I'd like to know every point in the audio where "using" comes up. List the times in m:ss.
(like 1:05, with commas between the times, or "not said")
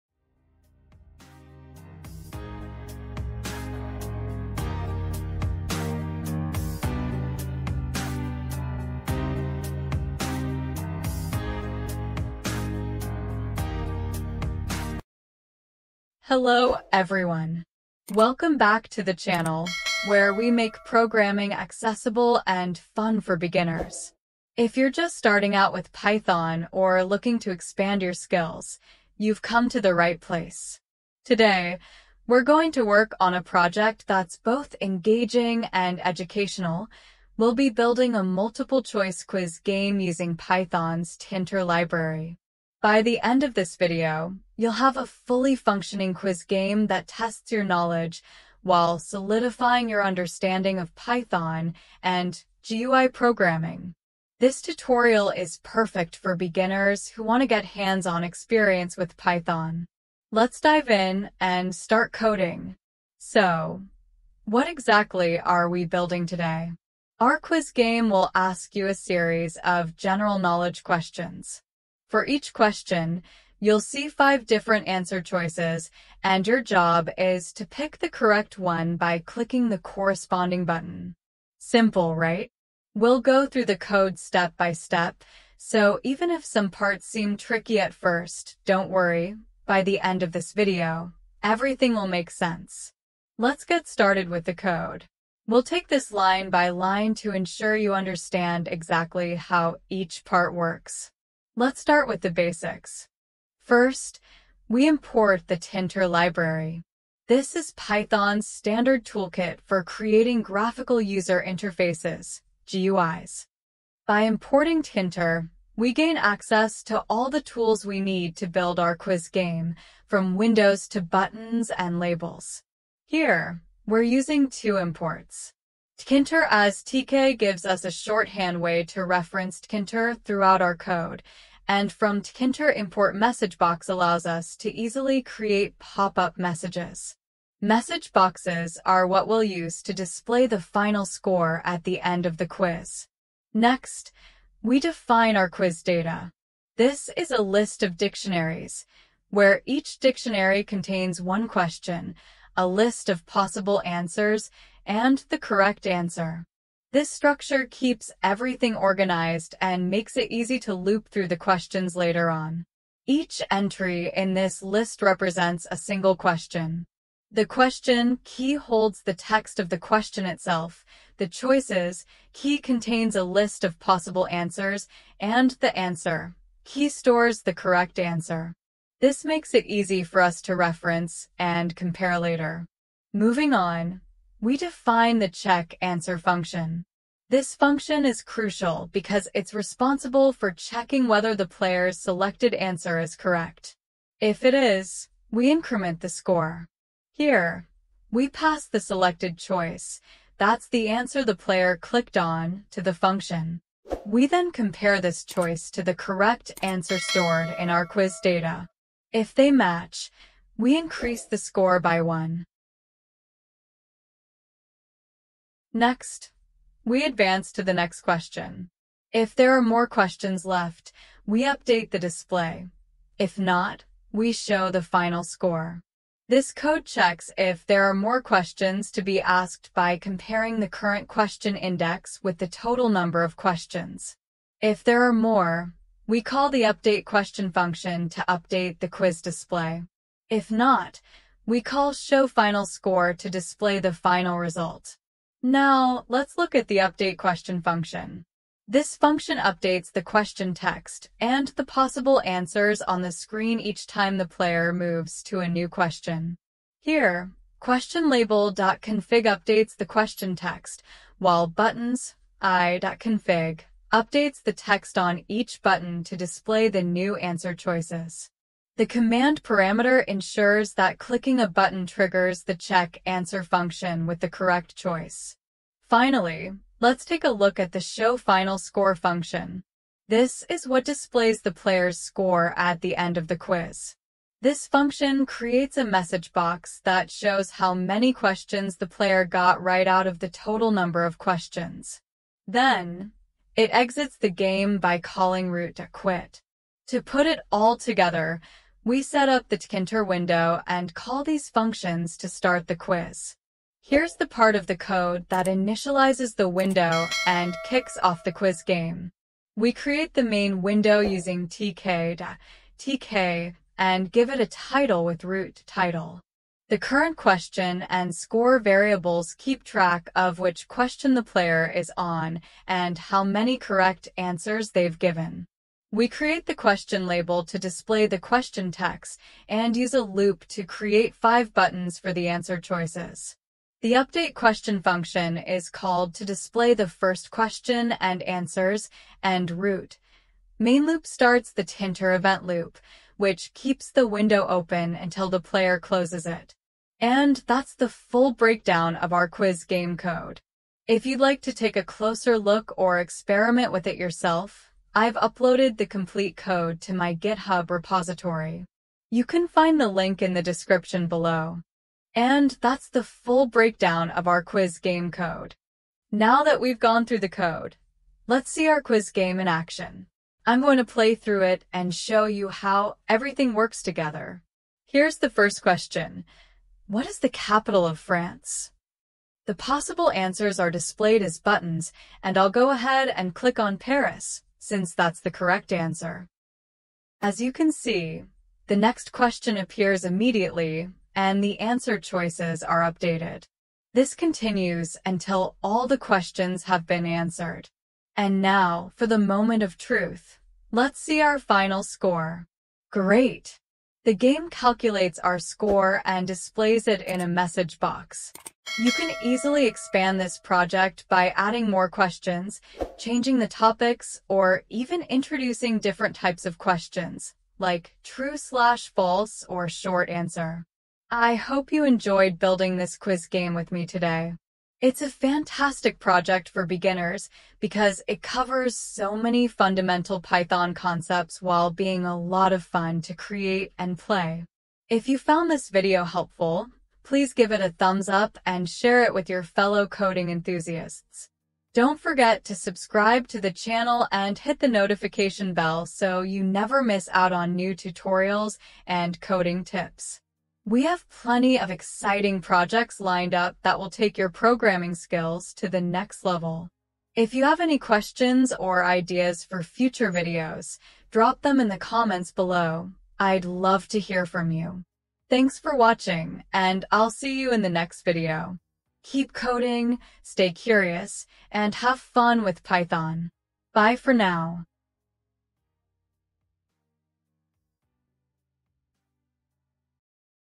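0:39, 2:04, 5:10.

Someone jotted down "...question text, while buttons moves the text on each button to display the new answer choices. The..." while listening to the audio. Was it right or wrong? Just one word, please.
wrong.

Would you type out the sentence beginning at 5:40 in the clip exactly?
Main loop starts the Tkinter event loop, which keeps the window open until the player closes it.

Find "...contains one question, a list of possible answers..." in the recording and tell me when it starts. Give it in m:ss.
2:30.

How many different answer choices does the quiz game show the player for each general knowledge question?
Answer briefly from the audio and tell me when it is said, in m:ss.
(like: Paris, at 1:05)
5, at 1:14.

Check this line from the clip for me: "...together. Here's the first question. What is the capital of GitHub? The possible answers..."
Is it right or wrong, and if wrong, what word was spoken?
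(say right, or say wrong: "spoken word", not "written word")
wrong: "France", not "GitHub".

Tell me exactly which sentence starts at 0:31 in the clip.
Today, we're going to work on a project that's both engaging and educational.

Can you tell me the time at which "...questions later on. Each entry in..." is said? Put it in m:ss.
2:41.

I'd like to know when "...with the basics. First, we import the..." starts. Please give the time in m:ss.
1:42.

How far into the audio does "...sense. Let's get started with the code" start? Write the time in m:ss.
1:32.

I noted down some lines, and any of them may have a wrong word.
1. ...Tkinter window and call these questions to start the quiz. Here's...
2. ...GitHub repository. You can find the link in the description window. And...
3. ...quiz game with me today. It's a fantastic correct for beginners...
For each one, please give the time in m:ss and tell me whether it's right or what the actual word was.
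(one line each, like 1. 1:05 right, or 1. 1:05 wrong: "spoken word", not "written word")
1. 4:59 wrong: "functions", not "questions"
2. 5:57 wrong: "below", not "window"
3. 7:02 wrong: "project", not "correct".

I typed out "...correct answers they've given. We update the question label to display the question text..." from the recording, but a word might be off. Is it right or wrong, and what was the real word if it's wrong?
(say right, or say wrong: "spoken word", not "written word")
wrong: "create", not "update".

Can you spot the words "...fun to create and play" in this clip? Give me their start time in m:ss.
7:12.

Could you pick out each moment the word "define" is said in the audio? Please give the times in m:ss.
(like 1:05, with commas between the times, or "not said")
2:24, 3:04.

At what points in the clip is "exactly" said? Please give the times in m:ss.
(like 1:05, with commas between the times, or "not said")
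1:04, 1:38.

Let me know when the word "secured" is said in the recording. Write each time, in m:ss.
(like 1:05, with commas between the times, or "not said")
not said.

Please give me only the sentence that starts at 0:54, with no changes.
This tutorial is perfect for beginners who want to get hands-on experience with Python.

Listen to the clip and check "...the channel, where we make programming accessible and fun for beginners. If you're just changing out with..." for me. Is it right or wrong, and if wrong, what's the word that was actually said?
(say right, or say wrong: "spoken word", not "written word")
wrong: "starting", not "changing".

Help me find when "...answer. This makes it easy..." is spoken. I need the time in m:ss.
2:57.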